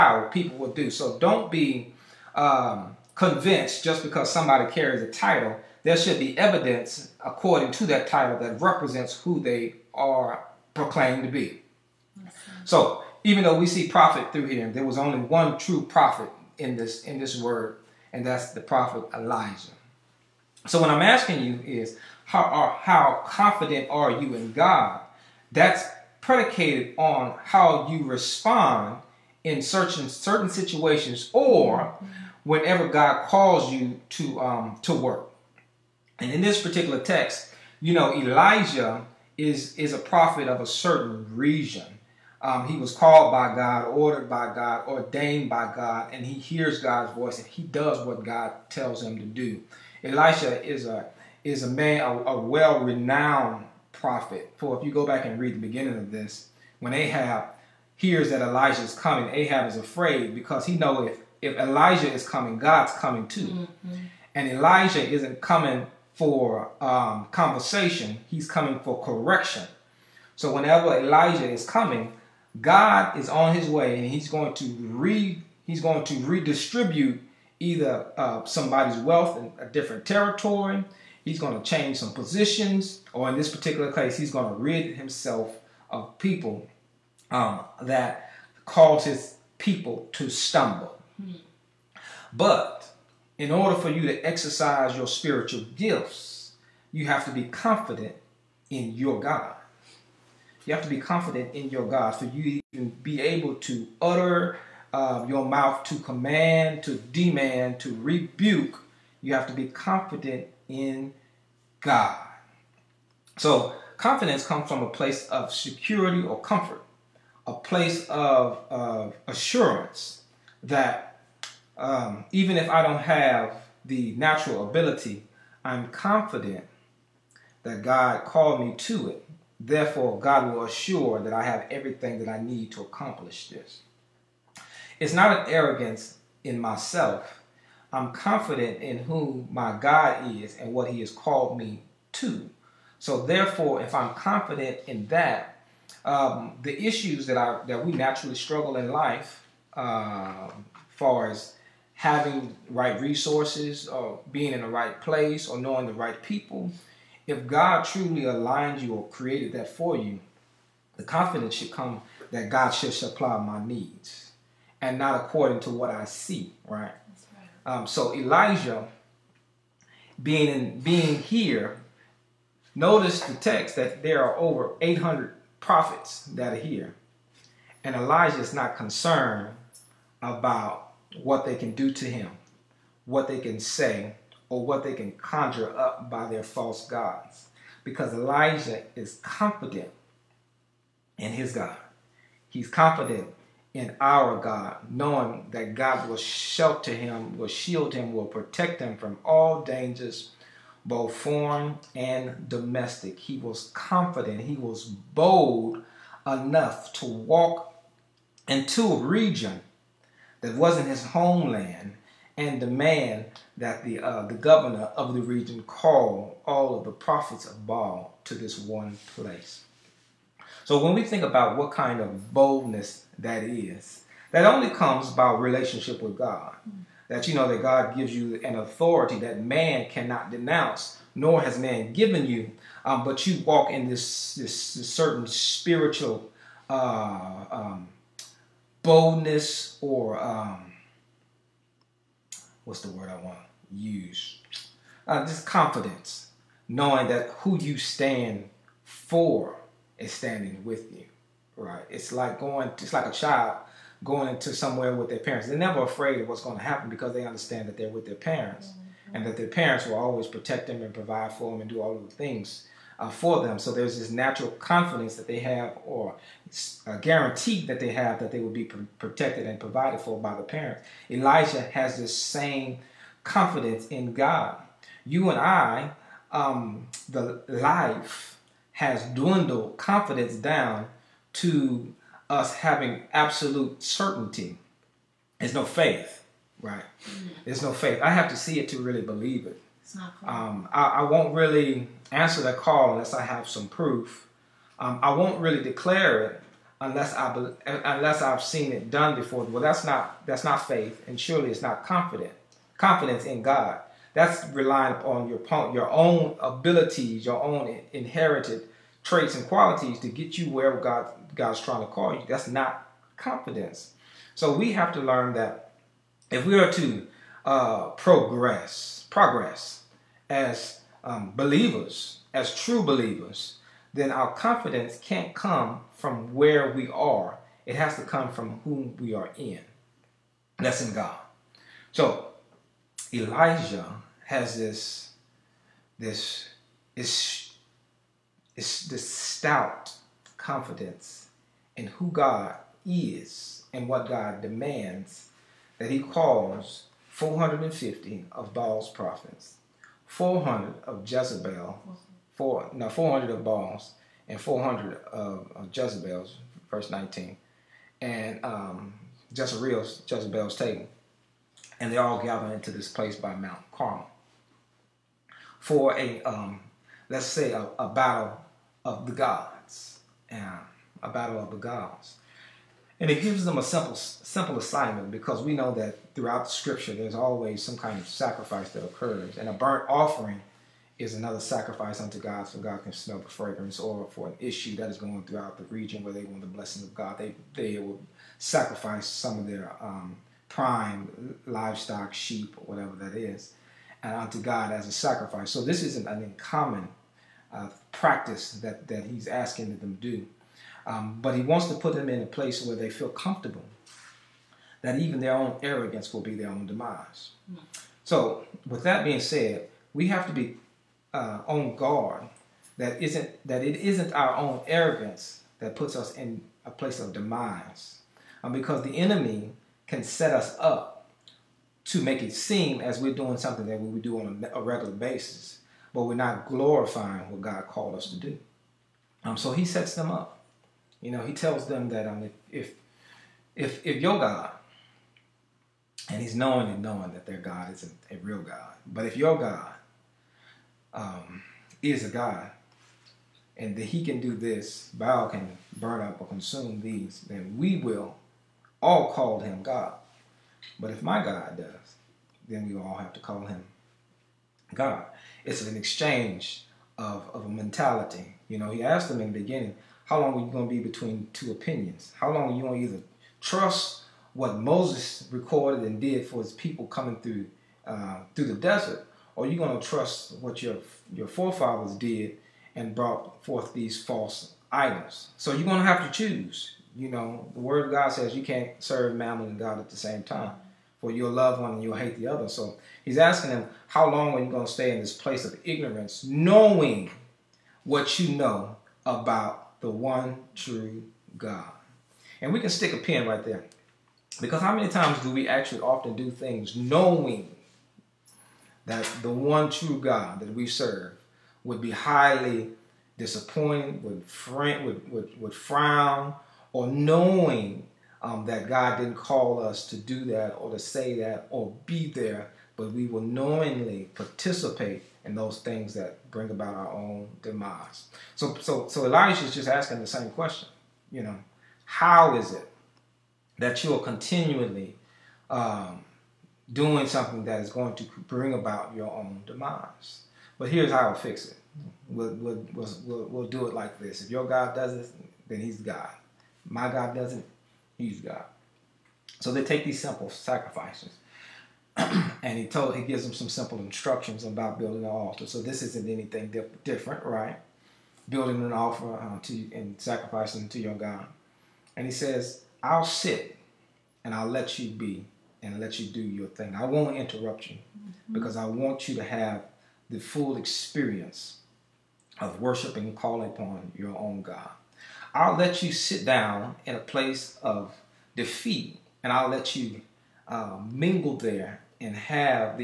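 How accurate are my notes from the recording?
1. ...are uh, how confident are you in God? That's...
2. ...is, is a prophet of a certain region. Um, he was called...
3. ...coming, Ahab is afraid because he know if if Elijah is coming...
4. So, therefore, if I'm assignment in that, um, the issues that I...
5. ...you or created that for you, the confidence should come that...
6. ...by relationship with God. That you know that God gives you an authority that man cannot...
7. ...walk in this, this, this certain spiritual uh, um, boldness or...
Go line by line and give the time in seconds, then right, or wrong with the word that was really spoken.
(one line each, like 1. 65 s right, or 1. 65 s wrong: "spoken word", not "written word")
1. 22 s right
2. 39 s right
3. 58 s right
4. 142 s wrong: "confident", not "assignment"
5. 158 s right
6. 225 s right
7. 233 s right.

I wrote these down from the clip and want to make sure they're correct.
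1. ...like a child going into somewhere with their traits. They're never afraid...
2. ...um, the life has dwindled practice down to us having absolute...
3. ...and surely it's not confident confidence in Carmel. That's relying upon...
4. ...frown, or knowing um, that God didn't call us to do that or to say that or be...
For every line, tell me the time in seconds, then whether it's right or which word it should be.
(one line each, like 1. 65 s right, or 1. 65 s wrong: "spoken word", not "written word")
1. 252 s wrong: "parents", not "traits"
2. 276 s wrong: "confidence", not "practice"
3. 301 s wrong: "God", not "Carmel"
4. 505 s right.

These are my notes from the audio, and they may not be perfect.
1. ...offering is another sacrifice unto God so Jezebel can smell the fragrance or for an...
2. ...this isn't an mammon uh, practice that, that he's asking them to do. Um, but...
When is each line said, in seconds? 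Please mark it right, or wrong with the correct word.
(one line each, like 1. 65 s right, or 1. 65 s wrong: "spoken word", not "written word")
1. 379 s wrong: "God", not "Jezebel"
2. 395 s wrong: "uncommon", not "mammon".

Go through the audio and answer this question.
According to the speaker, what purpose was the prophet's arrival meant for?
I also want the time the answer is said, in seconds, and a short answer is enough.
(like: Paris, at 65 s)
correction, at 68 s.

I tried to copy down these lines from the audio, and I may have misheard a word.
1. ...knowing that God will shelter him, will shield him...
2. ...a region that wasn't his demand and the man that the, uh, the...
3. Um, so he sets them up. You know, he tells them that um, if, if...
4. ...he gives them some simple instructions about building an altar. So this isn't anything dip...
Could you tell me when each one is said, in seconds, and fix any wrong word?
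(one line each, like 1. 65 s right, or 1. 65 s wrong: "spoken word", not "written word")
1. 194 s right
2. 208 s wrong: "homeland", not "demand"
3. 429 s right
4. 542 s right.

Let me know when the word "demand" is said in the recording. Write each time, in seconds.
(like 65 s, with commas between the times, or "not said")
106 s, 344 s.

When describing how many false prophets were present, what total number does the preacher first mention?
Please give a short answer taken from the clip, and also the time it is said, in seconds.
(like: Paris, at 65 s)
800, at 174 s.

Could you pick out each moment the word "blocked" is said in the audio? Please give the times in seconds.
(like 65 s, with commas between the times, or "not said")
not said.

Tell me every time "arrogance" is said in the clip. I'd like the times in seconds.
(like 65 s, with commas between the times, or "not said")
135 s, 405 s, 414 s.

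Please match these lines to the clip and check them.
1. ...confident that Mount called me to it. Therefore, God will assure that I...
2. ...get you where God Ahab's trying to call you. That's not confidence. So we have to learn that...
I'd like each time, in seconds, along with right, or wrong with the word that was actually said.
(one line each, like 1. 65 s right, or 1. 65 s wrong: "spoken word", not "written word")
1. 125 s wrong: "God", not "Mount"
2. 310 s wrong: "God", not "Ahab".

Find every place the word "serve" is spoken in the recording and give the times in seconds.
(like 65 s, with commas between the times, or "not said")
478 s, 500 s.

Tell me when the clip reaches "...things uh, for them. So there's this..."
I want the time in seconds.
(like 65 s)
262 s.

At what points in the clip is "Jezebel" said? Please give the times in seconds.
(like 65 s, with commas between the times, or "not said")
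351 s, 355 s, 360 s.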